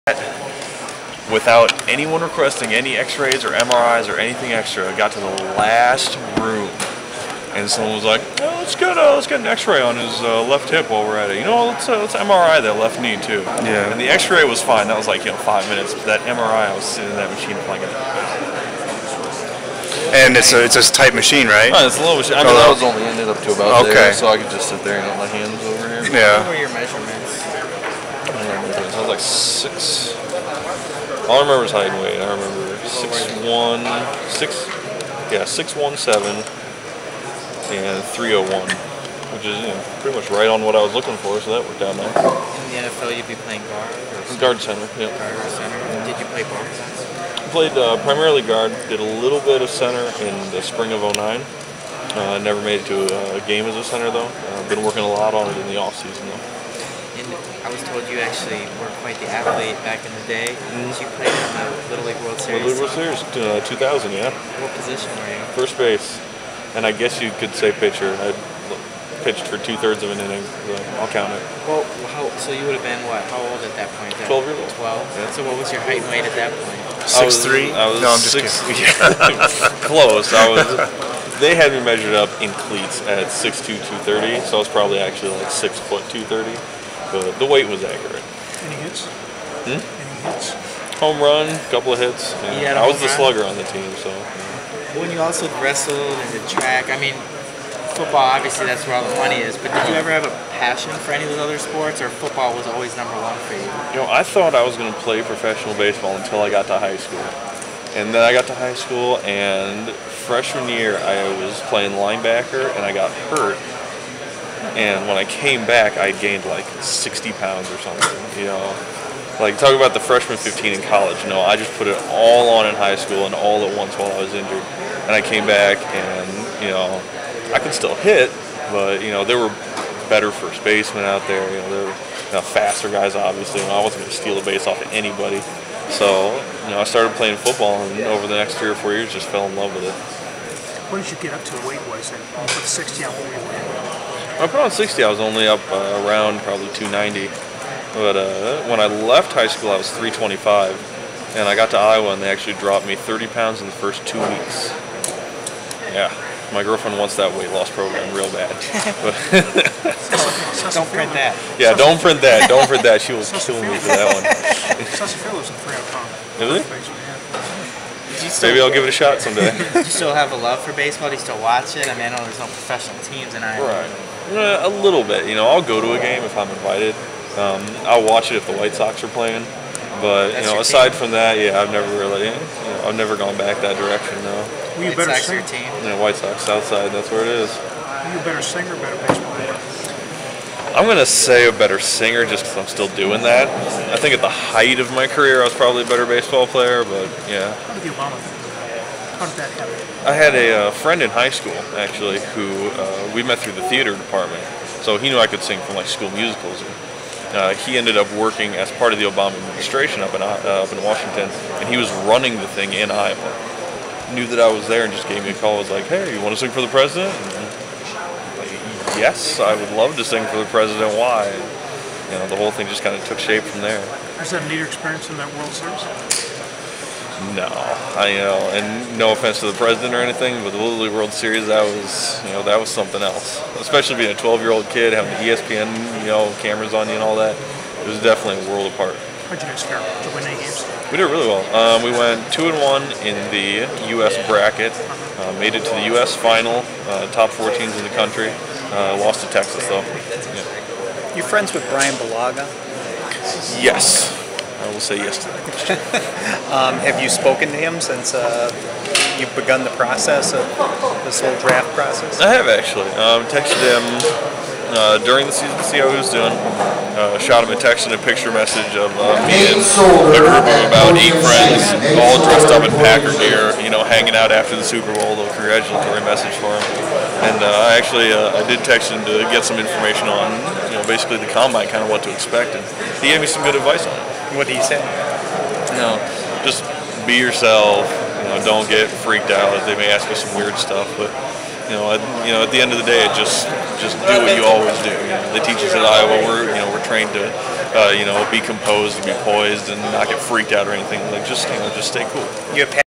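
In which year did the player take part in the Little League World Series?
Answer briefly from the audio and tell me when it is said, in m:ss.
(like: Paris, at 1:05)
2000, at 1:03.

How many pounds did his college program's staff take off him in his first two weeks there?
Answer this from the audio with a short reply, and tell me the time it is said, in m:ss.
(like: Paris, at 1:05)
30, at 2:32.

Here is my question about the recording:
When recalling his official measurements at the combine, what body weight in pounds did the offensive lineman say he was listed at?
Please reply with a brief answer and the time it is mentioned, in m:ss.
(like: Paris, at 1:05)
301, at 0:38.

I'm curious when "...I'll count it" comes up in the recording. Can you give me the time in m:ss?
1:10.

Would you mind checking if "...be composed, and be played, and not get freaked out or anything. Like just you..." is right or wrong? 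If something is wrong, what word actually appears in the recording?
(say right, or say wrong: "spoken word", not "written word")
wrong: "poised", not "played".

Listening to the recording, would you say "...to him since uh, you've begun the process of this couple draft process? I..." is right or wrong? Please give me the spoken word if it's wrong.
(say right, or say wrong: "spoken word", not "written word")
wrong: "whole", not "couple".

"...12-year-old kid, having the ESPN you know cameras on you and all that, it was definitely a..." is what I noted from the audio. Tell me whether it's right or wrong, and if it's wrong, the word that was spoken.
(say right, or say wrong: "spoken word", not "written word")
right.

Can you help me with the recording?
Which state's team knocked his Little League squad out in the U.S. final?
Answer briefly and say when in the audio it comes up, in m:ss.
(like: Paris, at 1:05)
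Texas, at 4:09.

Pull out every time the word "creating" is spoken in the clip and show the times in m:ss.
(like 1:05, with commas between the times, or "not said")
not said.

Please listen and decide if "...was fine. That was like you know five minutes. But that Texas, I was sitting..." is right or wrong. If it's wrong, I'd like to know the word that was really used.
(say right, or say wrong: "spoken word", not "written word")
wrong: "MRI", not "Texas".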